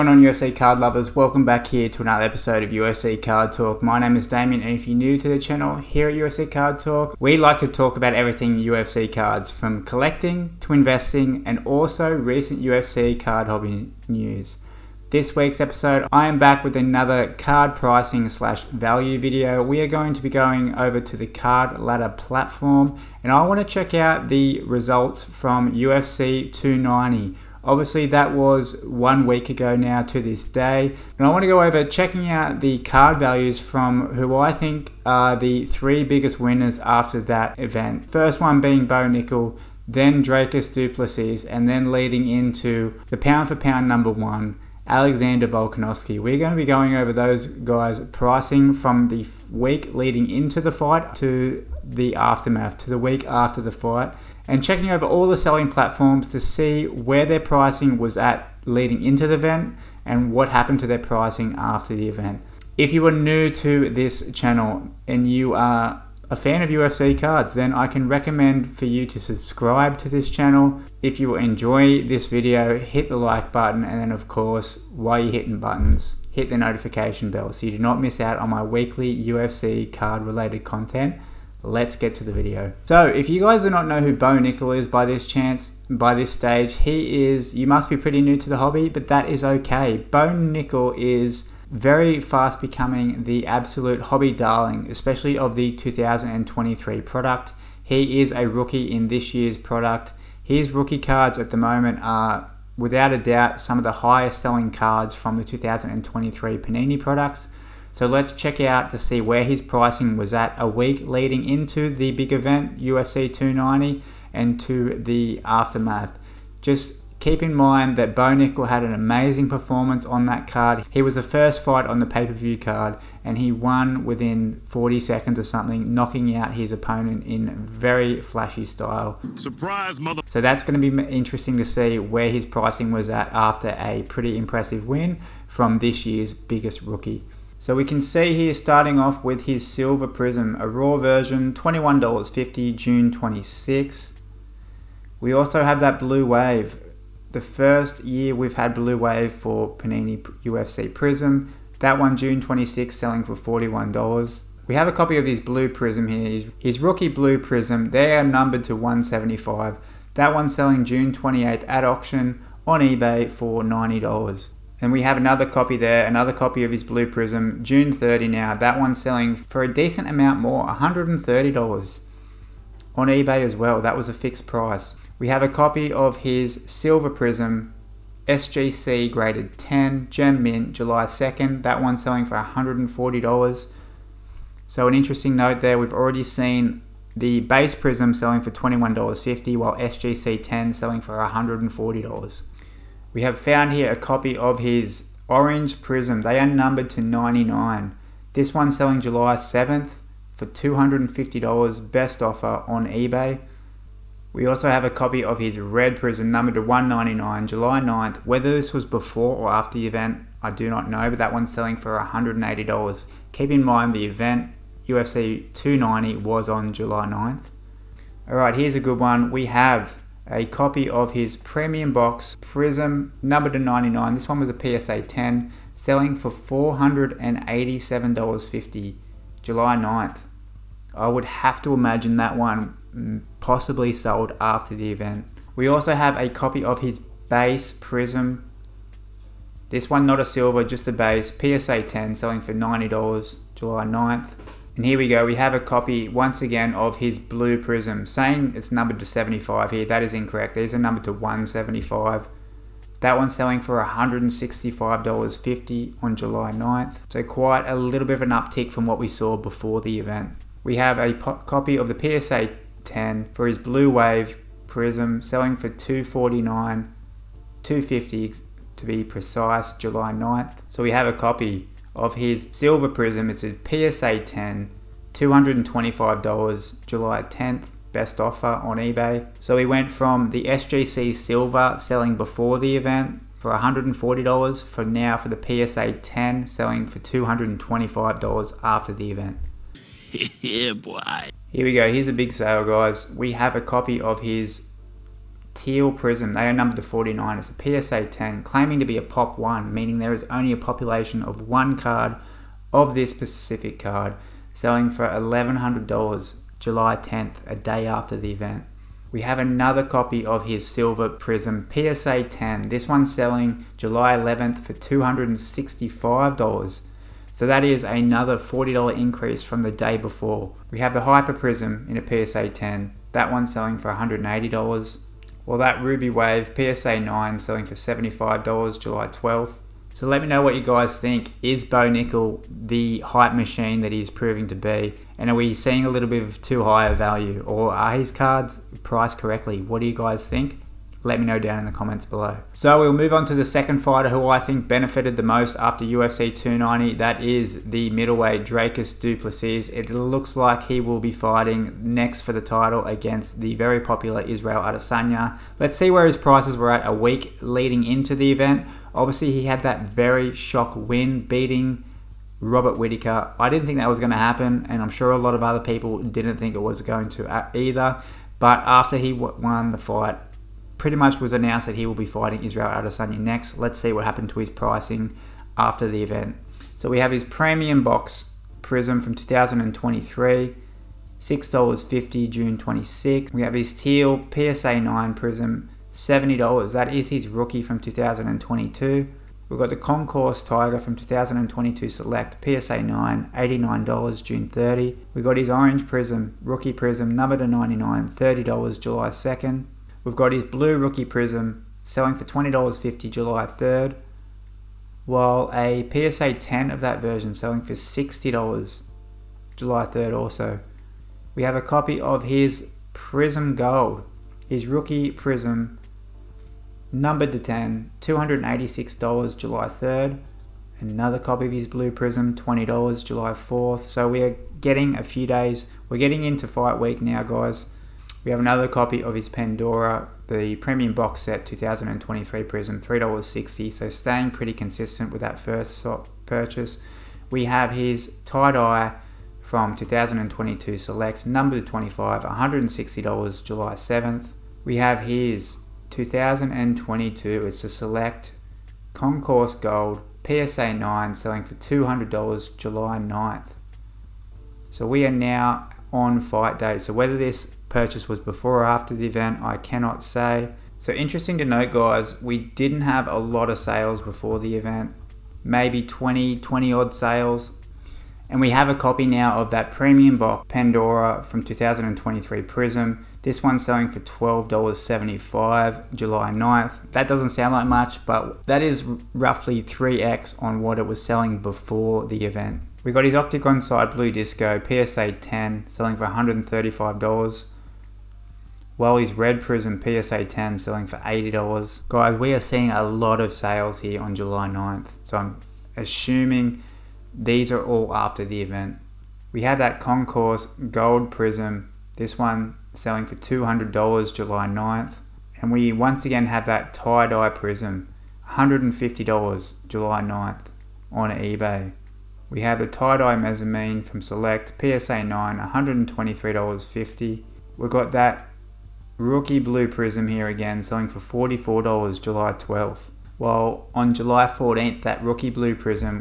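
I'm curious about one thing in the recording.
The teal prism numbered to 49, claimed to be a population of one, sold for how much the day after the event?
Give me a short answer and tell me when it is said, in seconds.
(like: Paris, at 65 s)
$1,100, at 305 s.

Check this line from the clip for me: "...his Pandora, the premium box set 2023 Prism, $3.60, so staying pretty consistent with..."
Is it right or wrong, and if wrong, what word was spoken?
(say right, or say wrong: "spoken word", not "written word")
right.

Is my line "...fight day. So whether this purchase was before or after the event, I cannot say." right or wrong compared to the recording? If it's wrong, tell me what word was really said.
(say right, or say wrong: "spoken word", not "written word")
right.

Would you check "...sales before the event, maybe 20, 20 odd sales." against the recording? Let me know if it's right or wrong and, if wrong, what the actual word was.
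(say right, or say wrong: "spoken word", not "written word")
right.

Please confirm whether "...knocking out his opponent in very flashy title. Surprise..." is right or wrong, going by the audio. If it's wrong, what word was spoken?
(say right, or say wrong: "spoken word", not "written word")
wrong: "style", not "title".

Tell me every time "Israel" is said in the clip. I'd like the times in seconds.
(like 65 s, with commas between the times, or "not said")
354 s, 372 s.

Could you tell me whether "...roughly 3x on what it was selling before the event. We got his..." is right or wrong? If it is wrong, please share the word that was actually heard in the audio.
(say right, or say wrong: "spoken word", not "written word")
right.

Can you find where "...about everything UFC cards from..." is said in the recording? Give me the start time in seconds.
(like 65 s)
7 s.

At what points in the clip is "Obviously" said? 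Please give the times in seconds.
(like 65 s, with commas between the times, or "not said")
27 s, 358 s.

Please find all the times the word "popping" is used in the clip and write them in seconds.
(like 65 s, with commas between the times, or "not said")
not said.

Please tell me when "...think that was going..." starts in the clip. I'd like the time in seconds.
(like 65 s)
363 s.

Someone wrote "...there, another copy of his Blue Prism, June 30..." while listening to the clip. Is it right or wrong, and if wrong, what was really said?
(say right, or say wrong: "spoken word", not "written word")
right.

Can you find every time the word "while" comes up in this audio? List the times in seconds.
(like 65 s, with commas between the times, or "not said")
74 s, 189 s, 405 s, 523 s.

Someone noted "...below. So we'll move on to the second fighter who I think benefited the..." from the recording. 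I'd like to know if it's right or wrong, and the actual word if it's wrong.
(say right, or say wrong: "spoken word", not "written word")
right.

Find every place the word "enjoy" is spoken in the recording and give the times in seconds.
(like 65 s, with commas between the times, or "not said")
71 s.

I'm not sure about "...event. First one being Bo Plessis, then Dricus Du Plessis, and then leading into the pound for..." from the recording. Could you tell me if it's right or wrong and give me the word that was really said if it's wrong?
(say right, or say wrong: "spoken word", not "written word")
wrong: "Nickal", not "Plessis".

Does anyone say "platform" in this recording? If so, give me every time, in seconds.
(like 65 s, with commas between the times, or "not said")
22 s, 55 s.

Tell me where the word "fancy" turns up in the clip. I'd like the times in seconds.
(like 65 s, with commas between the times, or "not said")
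not said.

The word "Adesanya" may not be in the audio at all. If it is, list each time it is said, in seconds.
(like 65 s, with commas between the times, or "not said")
354 s, 372 s.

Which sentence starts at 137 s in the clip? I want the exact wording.
So we can see here starting off with his silver prism, a raw version, $21.50, June 26.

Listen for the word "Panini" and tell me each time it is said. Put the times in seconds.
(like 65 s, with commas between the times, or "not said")
106 s, 149 s.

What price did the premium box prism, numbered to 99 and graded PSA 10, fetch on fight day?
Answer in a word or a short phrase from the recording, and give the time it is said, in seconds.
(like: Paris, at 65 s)
$487.50, at 226 s.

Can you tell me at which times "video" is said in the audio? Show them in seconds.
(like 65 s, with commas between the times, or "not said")
19 s, 72 s, 82 s.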